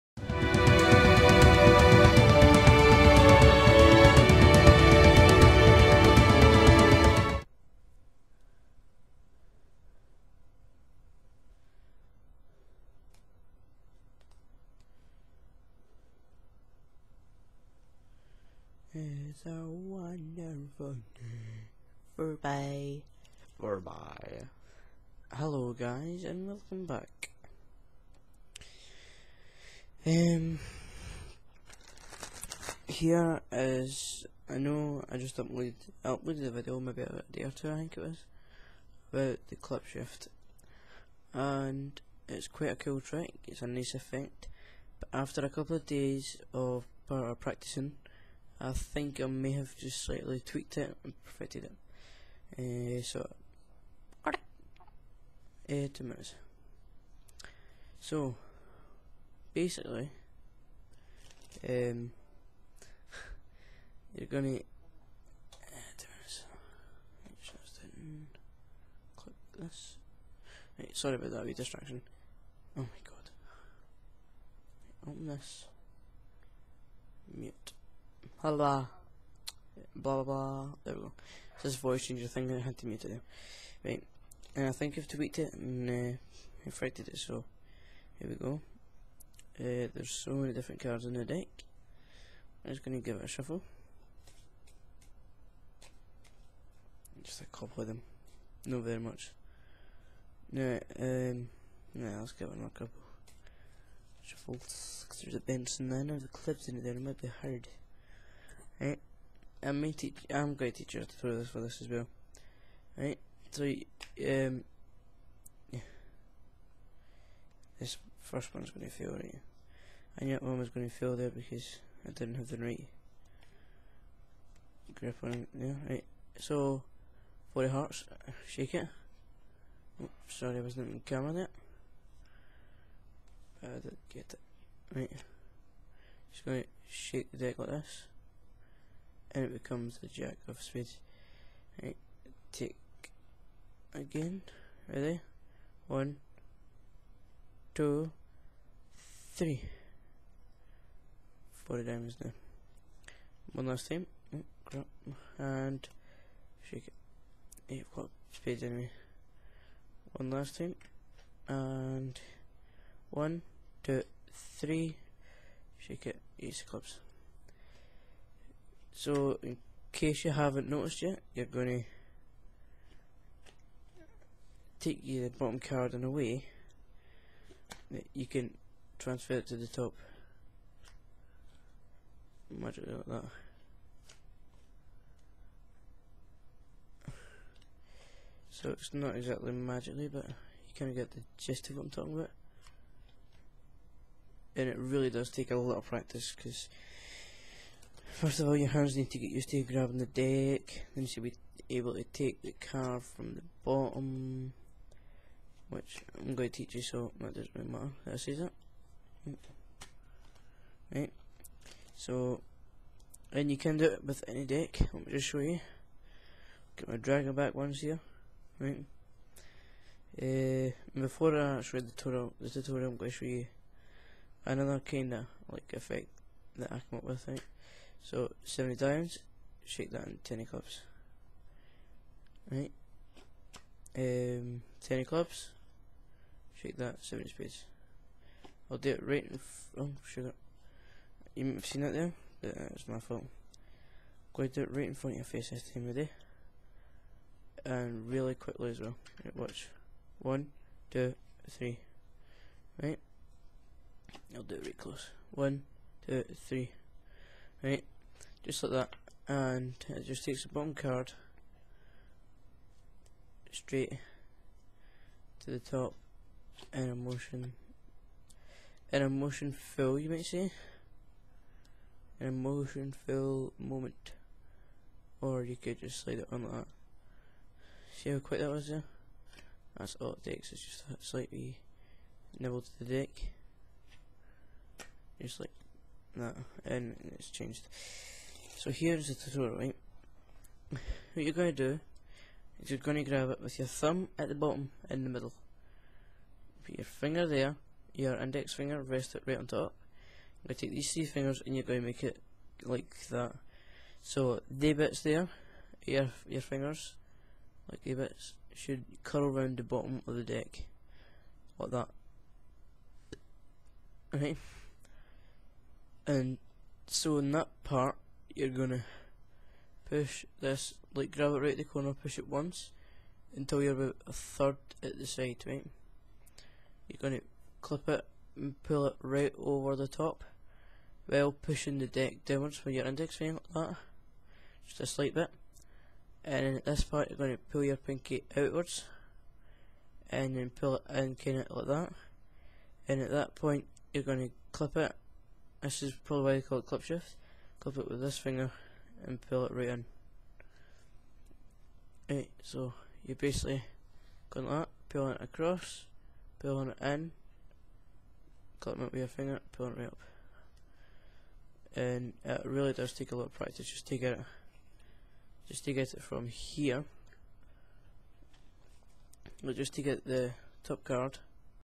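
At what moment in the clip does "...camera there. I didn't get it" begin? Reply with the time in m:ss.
2:11.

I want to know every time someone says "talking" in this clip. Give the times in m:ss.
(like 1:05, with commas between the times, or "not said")
3:11.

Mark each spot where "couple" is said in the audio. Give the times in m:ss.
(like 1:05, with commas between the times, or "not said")
0:45, 1:37, 1:42.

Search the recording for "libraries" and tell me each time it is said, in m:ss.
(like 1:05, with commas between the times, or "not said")
not said.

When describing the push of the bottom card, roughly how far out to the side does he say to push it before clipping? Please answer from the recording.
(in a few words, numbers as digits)
about a third.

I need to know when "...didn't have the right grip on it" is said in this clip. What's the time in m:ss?
2:02.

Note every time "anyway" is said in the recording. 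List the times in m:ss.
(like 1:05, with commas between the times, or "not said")
2:38.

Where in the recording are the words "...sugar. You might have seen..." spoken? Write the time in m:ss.
4:00.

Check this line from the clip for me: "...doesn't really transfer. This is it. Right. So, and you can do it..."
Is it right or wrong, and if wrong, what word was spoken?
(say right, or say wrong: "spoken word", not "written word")
wrong: "matter", not "transfer".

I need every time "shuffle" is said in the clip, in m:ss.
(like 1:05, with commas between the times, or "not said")
1:33, 1:44.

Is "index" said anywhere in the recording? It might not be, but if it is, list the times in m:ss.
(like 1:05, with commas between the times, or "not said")
4:58, 5:32.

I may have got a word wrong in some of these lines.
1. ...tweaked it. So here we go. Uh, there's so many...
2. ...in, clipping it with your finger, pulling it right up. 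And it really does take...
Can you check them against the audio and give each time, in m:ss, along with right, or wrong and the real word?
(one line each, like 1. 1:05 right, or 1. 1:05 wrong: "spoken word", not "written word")
1. 1:26 wrong: "frighted", not "tweaked"
2. 5:56 right.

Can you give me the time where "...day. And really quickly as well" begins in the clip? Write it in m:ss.
4:05.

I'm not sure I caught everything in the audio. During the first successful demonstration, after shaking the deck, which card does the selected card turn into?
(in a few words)
jack of spades.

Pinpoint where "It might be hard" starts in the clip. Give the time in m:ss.
1:46.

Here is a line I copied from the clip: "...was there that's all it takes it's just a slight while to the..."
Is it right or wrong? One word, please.
wrong.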